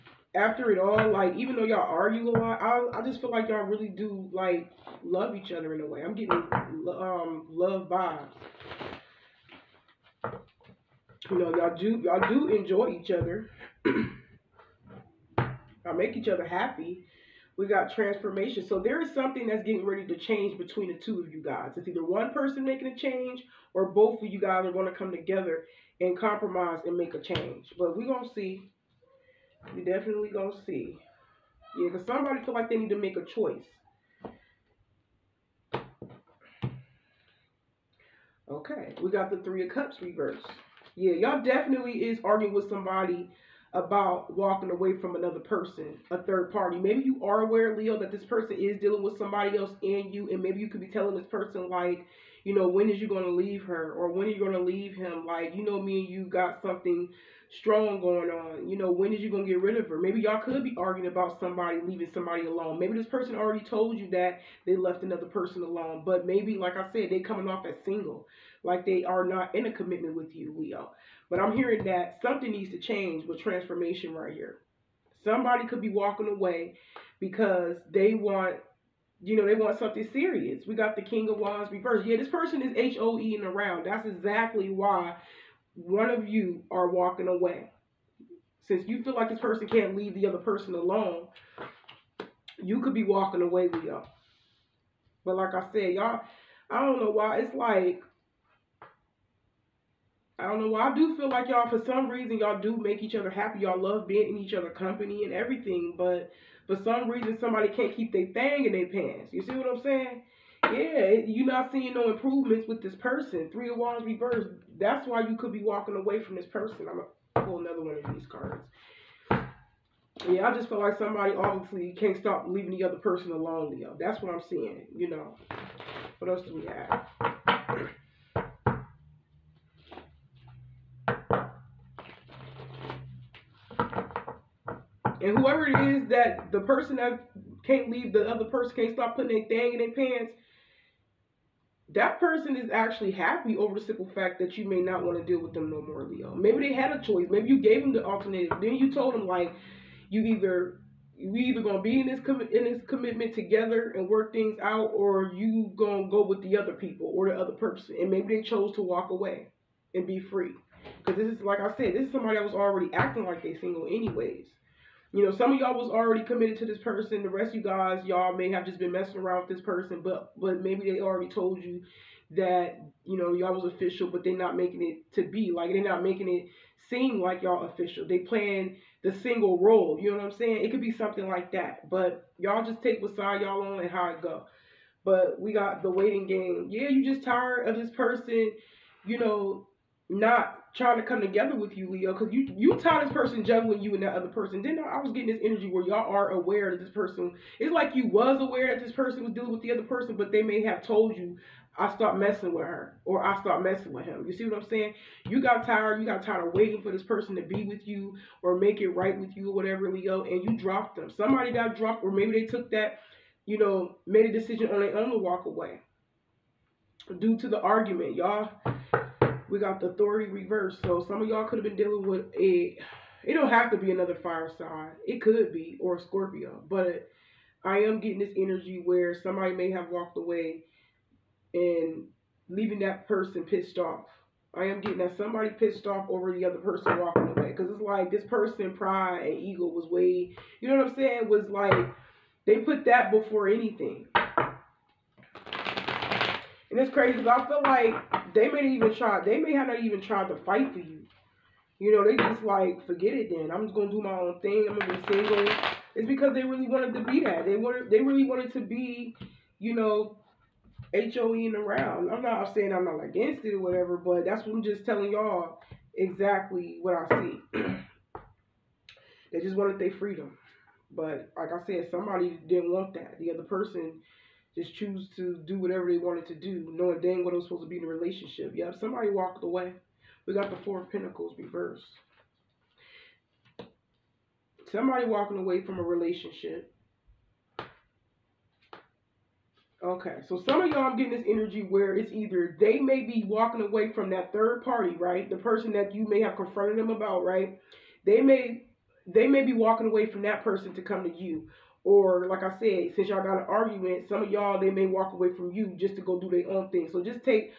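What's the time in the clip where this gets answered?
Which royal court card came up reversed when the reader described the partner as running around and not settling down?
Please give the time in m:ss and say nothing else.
1:21.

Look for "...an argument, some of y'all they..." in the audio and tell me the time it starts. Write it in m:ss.
5:03.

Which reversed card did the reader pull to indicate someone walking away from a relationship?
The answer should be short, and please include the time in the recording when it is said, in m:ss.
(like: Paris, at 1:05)
Four of Pentacles, at 4:40.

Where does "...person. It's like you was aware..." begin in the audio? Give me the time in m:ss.
3:16.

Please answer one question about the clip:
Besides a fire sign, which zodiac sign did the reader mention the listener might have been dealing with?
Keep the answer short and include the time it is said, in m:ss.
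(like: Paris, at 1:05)
Scorpio, at 3:45.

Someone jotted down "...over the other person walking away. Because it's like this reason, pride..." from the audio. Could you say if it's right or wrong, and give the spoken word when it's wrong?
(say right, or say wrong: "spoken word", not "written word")
wrong: "person", not "reason".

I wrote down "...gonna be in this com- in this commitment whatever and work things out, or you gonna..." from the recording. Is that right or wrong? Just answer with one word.
wrong.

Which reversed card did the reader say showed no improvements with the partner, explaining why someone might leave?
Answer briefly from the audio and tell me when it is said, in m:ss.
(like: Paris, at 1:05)
Three of Wands, at 1:53.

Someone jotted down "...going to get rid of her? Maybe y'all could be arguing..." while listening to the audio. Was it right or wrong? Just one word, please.
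right.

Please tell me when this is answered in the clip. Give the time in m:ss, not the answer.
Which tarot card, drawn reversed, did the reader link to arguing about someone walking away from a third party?
0:39.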